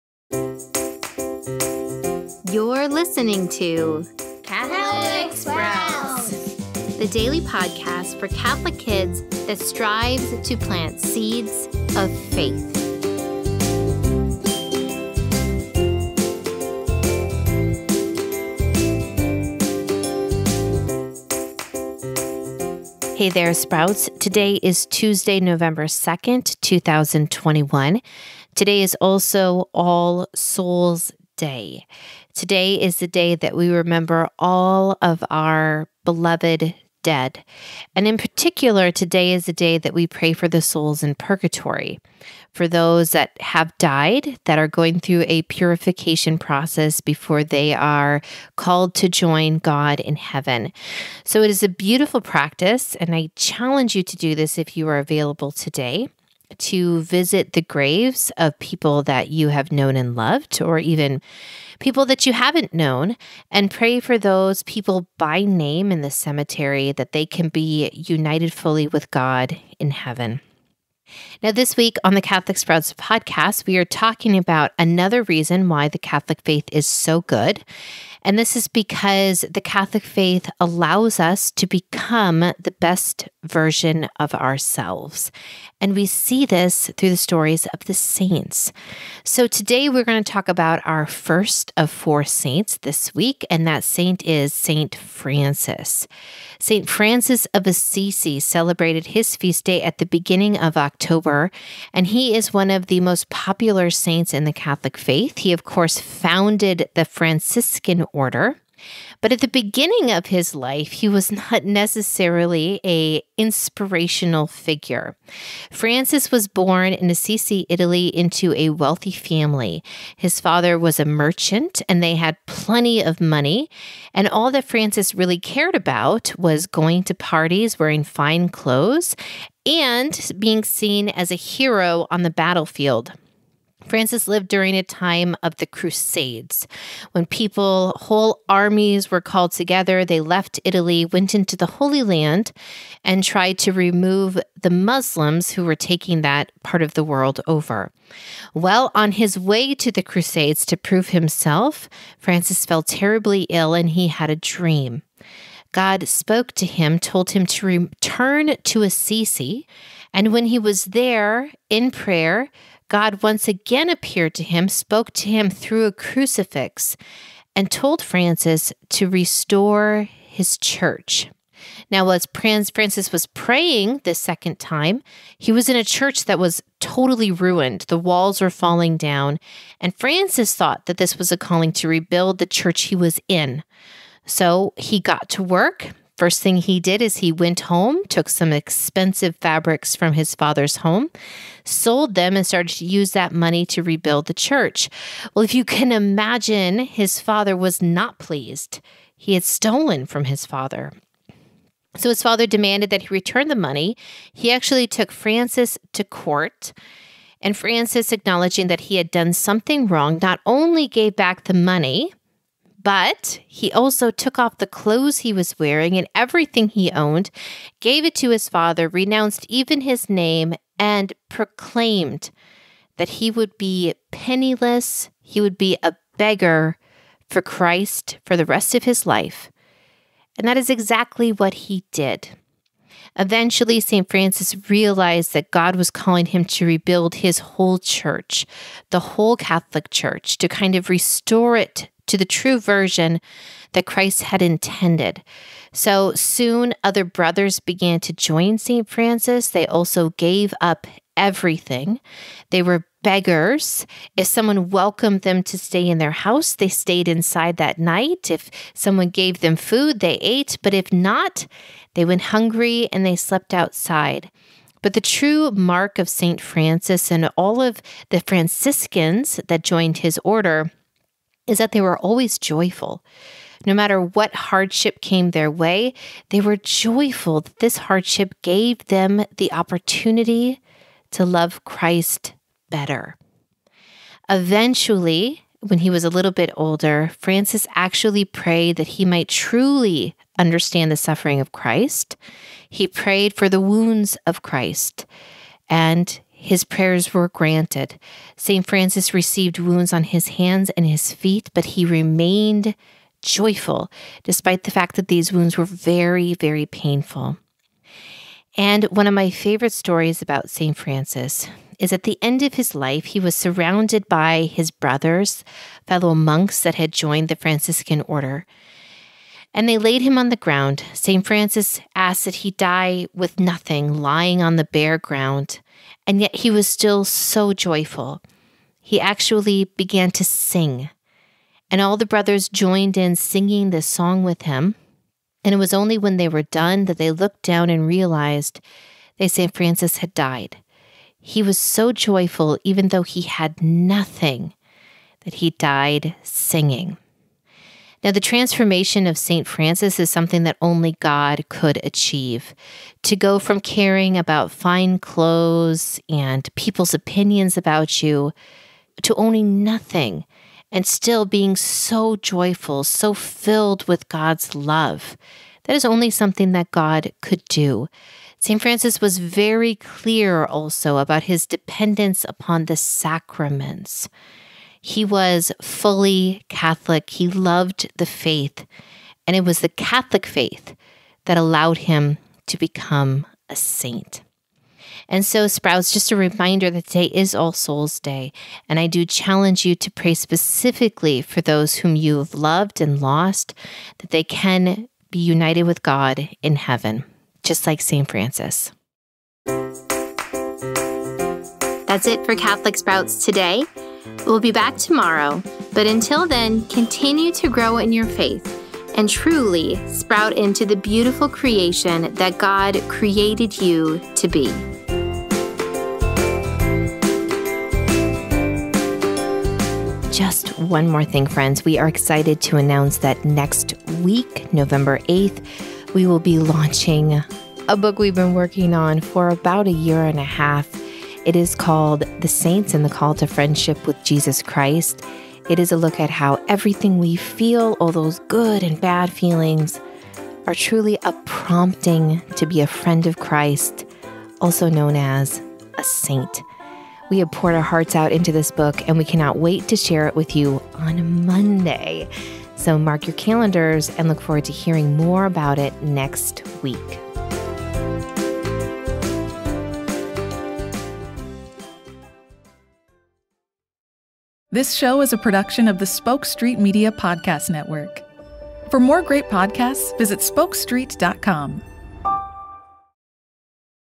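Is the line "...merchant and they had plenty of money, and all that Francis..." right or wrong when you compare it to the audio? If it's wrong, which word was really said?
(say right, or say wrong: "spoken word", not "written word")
right.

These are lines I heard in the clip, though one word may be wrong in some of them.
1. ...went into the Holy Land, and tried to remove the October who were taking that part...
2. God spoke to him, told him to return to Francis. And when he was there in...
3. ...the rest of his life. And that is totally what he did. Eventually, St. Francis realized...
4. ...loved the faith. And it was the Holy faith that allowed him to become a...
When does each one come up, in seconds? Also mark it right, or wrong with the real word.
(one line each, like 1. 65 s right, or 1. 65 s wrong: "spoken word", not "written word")
1. 141 s wrong: "Muslims", not "October"
2. 155 s wrong: "Assisi", not "Francis"
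3. 228 s wrong: "exactly", not "totally"
4. 377 s wrong: "Catholic", not "Holy".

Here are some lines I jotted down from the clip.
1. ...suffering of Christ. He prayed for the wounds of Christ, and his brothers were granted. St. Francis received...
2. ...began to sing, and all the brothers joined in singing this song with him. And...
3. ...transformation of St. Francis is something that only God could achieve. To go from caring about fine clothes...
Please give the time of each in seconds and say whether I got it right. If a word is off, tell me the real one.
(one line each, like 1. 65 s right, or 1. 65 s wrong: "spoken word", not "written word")
1. 290 s wrong: "prayers", not "brothers"
2. 329 s right
3. 348 s right.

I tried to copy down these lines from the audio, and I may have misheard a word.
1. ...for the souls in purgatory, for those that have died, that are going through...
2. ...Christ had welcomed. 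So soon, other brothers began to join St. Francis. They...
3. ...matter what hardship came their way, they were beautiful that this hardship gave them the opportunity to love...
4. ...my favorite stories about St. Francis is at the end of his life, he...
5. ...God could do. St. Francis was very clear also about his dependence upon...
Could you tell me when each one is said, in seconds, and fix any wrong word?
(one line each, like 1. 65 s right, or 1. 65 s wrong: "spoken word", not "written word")
1. 40 s right
2. 243 s wrong: "intended", not "welcomed"
3. 273 s wrong: "joyful", not "beautiful"
4. 309 s right
5. 366 s right.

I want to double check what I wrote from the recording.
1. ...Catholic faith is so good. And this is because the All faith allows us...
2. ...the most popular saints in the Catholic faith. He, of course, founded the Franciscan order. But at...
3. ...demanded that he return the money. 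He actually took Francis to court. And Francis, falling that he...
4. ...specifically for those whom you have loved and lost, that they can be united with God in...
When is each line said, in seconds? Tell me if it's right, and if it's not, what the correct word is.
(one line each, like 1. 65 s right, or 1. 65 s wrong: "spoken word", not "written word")
1. 75 s wrong: "Catholic", not "All"
2. 102 s right
3. 202 s wrong: "acknowledging", not "falling"
4. 390 s right.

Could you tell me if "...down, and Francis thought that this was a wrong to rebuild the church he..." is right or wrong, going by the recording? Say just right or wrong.
wrong.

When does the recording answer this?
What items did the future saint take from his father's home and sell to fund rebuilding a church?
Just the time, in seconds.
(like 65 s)
188 s.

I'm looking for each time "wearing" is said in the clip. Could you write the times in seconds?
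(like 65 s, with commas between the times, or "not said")
127 s, 215 s.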